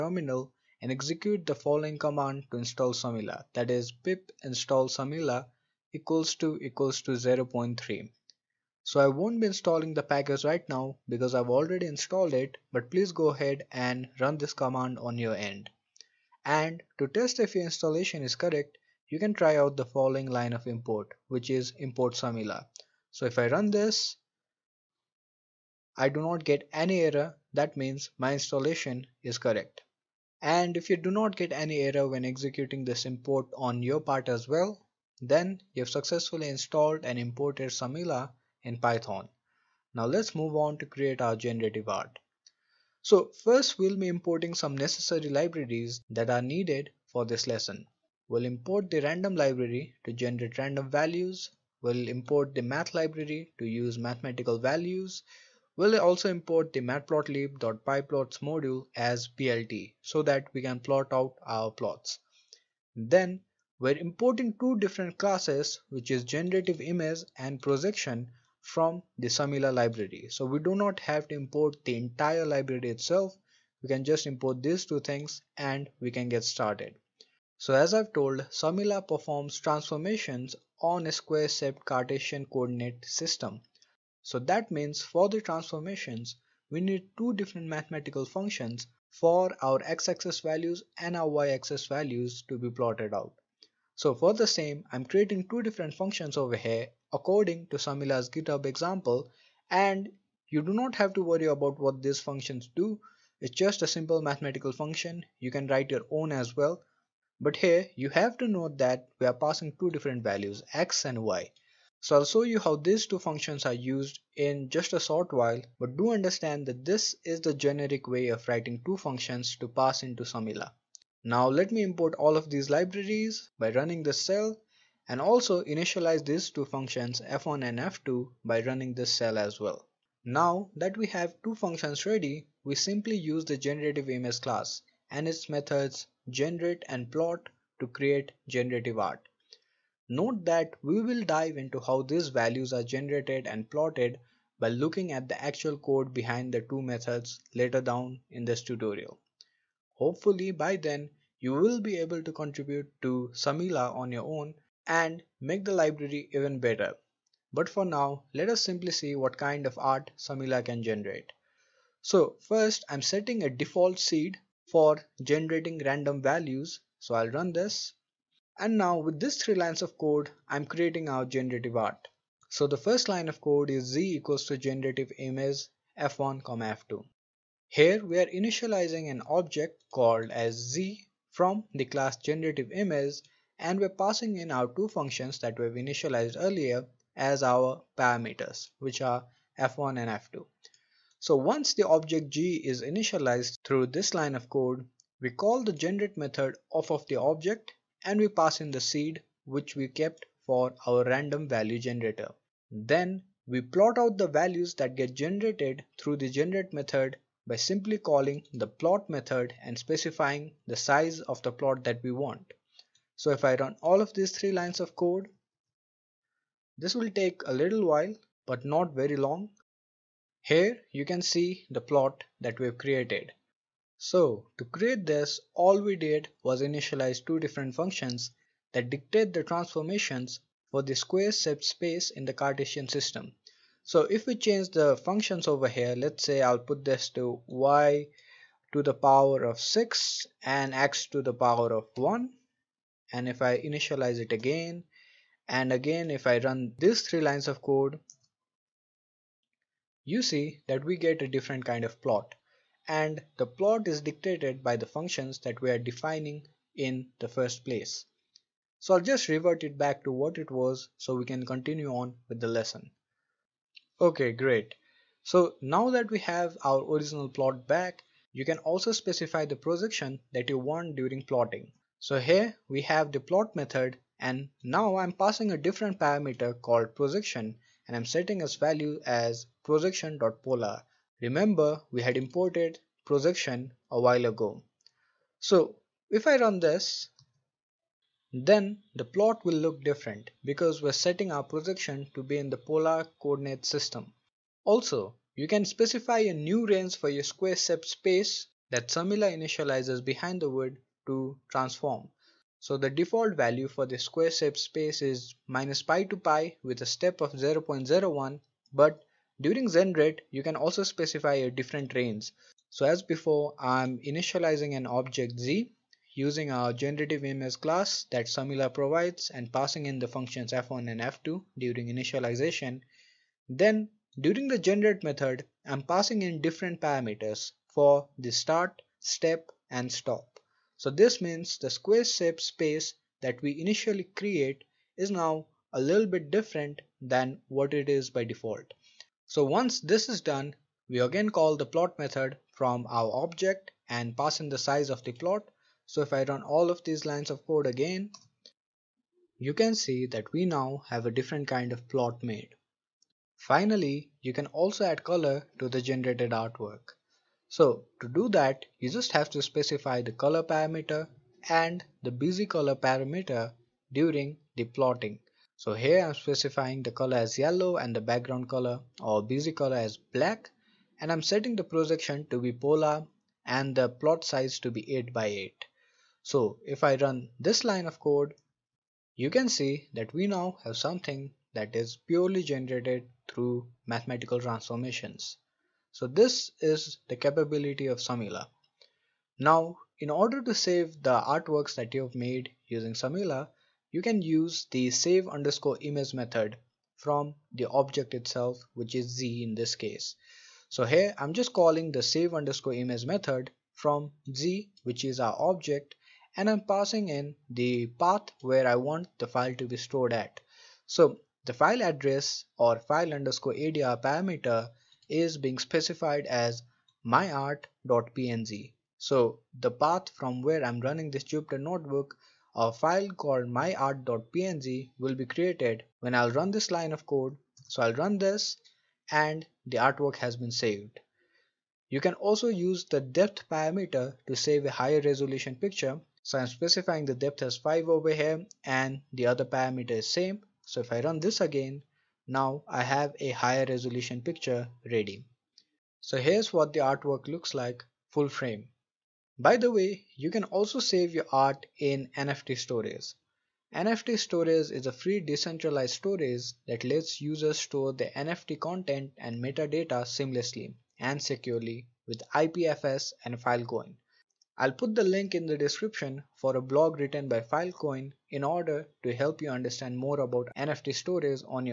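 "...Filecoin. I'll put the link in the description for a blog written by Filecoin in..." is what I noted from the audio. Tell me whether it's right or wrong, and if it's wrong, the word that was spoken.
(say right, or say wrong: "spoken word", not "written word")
right.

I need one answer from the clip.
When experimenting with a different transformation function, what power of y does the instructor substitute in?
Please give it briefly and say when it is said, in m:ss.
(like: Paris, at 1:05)
6, at 3:59.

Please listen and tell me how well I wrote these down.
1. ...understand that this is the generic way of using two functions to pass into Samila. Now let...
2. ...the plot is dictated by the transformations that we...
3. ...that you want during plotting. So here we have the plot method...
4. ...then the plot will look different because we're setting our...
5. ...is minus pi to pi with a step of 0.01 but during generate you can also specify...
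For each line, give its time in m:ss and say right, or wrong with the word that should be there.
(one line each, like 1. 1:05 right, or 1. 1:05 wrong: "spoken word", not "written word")
1. 1:56 wrong: "writing", not "using"
2. 4:13 wrong: "functions", not "transformations"
3. 4:30 right
4. 4:48 right
5. 5:05 right.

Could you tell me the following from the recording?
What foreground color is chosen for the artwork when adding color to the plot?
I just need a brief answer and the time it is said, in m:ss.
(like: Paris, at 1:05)
yellow, at 6:07.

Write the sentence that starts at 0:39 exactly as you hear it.
Now let's move on to create our generative art.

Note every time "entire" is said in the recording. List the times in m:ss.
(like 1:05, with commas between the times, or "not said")
1:11.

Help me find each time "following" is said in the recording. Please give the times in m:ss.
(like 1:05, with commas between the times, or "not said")
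0:01, 0:19.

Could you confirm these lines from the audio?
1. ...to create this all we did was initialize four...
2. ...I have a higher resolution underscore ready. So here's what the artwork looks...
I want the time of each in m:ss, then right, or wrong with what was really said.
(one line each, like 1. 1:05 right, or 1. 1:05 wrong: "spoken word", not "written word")
1. 3:44 wrong: "two", not "four"
2. 7:22 wrong: "picture", not "underscore".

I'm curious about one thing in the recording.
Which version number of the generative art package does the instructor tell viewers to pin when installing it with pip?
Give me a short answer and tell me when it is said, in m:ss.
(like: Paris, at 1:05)
0.3, at 0:07.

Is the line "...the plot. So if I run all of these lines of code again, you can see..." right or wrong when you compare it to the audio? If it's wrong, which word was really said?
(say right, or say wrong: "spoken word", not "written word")
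right.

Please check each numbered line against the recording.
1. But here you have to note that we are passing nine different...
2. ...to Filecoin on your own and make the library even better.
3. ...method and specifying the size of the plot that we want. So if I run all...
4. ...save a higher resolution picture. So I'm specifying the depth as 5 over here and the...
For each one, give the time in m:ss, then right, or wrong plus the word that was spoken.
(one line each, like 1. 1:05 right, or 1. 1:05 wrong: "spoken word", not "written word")
1. 1:47 wrong: "two", not "nine"
2. 2:33 wrong: "Samila", not "Filecoin"
3. 3:29 right
4. 7:14 right.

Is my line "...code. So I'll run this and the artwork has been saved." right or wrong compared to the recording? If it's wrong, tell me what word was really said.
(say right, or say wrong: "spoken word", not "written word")
right.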